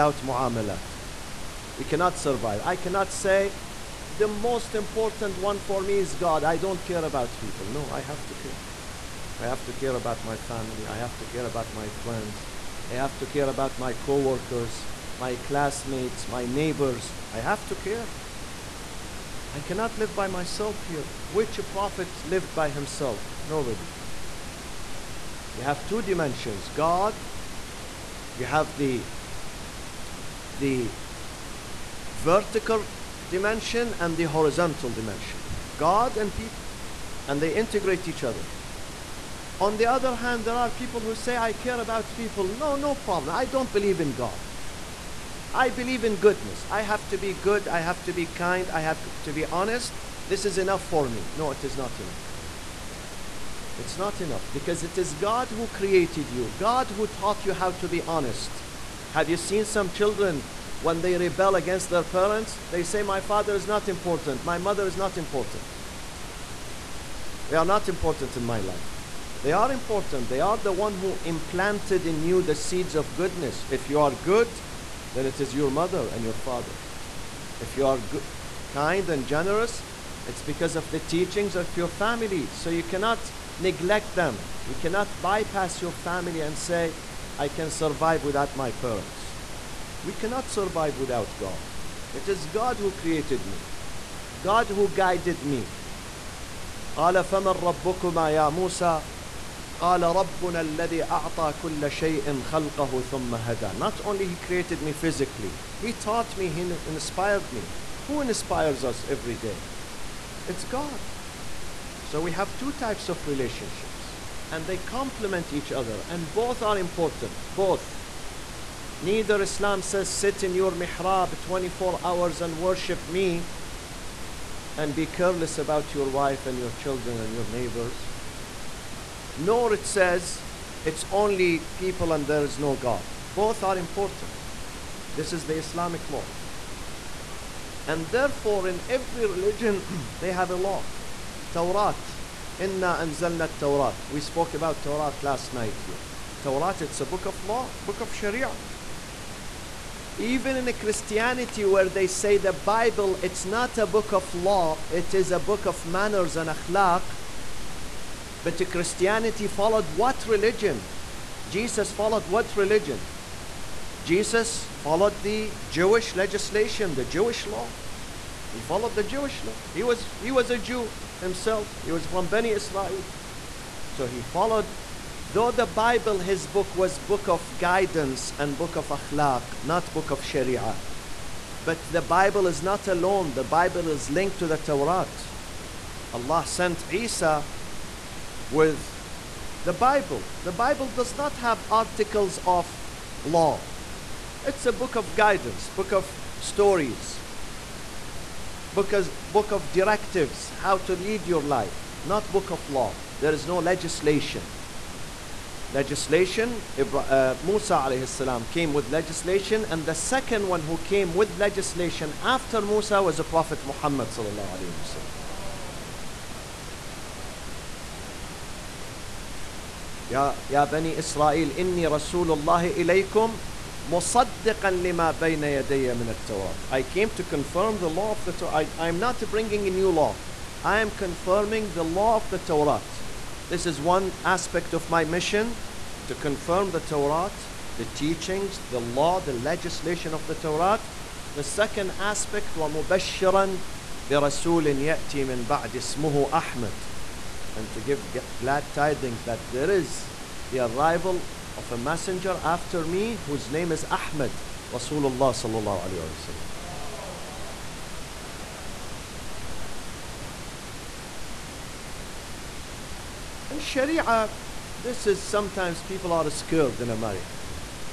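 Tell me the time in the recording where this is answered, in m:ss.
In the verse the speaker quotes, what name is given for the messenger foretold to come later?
4:13.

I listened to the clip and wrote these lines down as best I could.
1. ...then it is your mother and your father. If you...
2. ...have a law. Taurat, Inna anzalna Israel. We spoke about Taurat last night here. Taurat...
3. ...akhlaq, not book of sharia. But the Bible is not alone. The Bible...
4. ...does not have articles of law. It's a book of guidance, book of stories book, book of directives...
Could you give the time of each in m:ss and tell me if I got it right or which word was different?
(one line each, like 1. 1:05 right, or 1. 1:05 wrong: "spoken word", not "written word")
1. 1:15 right
2. 2:20 wrong: "Taurat", not "Israel"
3. 2:58 right
4. 3:10 right.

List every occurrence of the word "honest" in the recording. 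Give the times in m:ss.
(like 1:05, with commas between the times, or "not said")
0:49, 0:58.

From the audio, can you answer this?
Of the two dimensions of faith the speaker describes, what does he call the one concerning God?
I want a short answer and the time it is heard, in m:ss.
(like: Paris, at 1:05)
Vertical dimension, at 0:30.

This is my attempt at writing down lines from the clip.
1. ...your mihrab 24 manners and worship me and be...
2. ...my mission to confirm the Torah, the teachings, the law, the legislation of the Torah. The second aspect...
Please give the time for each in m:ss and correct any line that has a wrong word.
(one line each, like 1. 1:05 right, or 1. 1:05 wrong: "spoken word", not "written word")
1. 2:00 wrong: "hours", not "manners"
2. 3:54 right.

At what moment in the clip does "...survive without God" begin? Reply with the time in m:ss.
1:30.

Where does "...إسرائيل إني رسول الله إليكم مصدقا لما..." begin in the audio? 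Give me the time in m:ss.
3:40.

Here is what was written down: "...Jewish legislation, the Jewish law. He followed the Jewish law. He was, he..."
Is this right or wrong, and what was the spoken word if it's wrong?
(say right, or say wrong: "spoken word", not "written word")
right.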